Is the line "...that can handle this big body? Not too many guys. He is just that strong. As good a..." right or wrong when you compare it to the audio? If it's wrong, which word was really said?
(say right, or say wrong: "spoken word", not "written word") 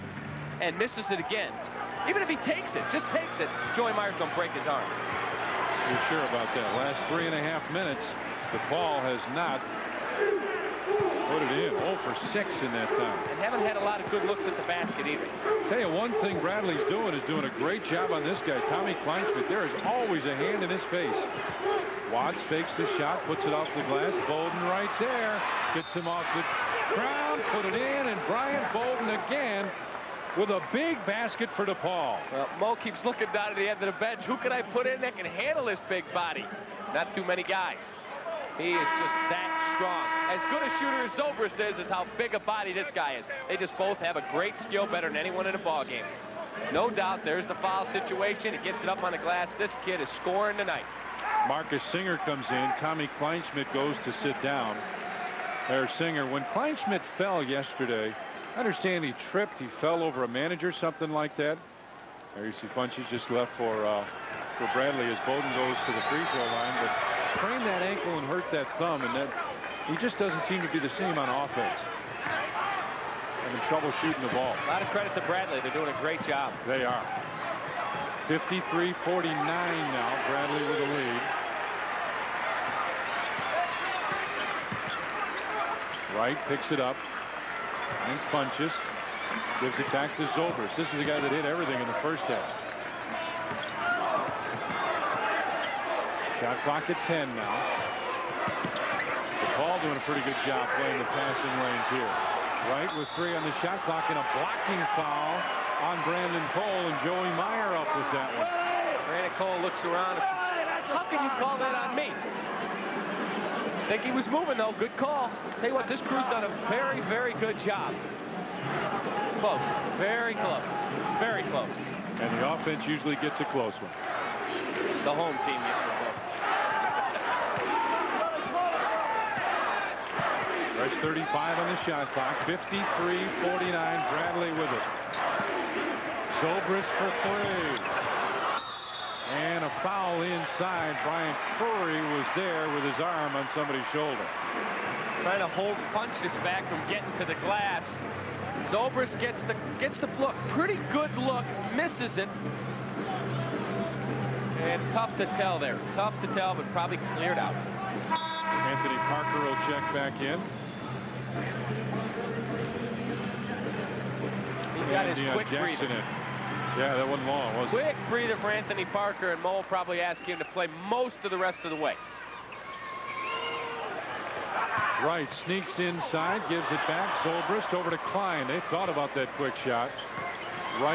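right.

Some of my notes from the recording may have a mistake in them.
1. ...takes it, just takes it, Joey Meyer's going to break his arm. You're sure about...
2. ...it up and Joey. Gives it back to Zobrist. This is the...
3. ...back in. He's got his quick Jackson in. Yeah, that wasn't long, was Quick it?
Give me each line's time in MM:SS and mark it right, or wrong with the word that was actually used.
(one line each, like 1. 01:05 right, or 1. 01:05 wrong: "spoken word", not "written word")
1. 00:02 right
2. 01:26 wrong: "Funches", not "Joey"
3. 02:39 right.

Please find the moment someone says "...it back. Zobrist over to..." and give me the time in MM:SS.
02:56.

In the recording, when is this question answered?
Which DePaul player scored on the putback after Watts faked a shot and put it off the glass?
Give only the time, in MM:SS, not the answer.
00:28.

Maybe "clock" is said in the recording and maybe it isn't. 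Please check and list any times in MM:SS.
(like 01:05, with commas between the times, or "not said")
01:36, 01:43, 02:12.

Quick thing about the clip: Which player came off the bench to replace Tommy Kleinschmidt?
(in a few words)
Marcus Singer.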